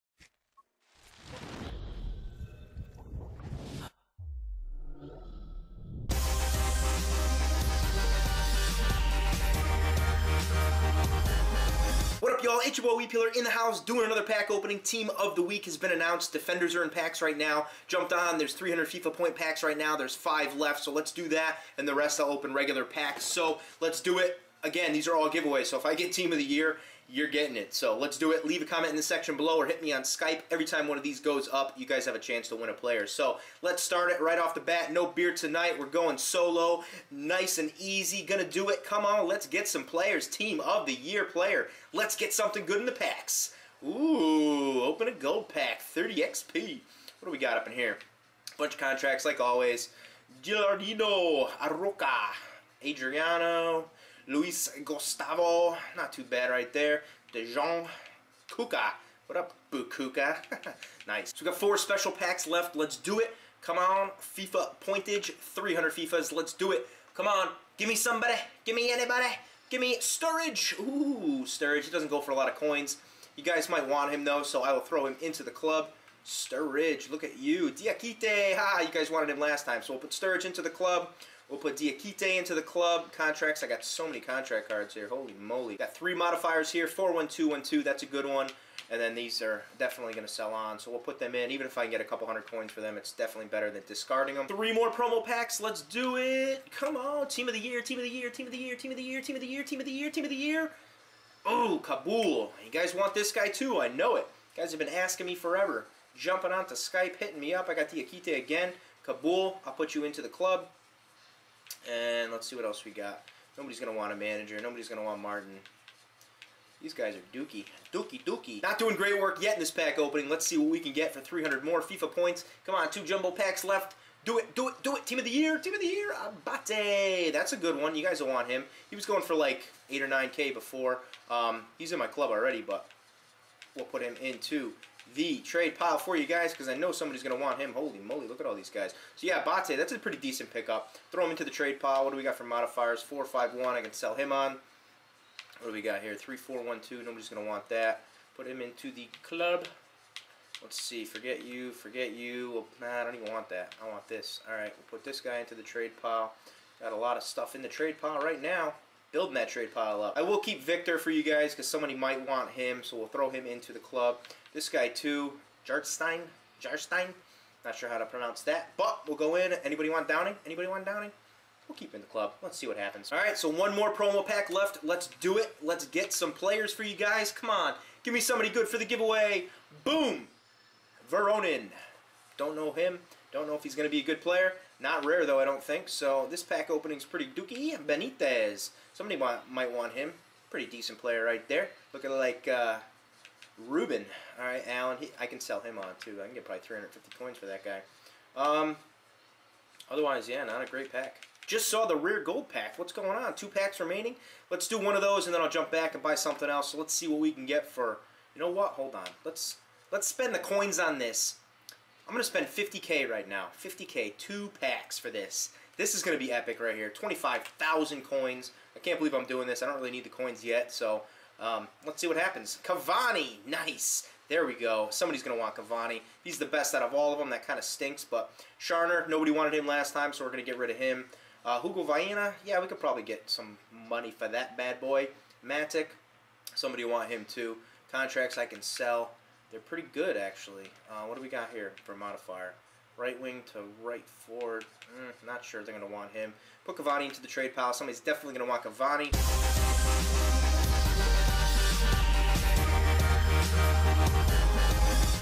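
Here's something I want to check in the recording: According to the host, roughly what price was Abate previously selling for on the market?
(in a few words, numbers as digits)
8 or 9K.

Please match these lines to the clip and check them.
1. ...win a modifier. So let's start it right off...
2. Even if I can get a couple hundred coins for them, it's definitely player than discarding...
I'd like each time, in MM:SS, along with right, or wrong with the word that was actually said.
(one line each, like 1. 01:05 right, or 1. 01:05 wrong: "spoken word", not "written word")
1. 00:32 wrong: "player", not "modifier"
2. 01:31 wrong: "better", not "player".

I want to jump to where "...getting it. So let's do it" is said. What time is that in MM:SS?
00:27.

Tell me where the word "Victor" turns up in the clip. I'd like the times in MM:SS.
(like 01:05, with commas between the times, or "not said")
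02:40.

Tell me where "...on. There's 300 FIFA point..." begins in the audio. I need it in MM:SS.
00:18.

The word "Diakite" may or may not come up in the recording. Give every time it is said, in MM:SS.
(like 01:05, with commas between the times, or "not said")
01:17, 01:21, 01:47.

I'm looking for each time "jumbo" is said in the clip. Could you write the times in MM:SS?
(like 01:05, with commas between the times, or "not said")
02:03.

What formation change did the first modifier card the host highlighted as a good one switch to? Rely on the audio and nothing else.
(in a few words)
4-1-2-1-2.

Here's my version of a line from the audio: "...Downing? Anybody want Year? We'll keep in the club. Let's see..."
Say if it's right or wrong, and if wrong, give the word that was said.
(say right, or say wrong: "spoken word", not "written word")
wrong: "Downing", not "Year".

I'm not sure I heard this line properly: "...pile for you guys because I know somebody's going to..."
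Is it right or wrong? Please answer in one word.
right.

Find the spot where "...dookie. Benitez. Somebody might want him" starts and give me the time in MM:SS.
03:07.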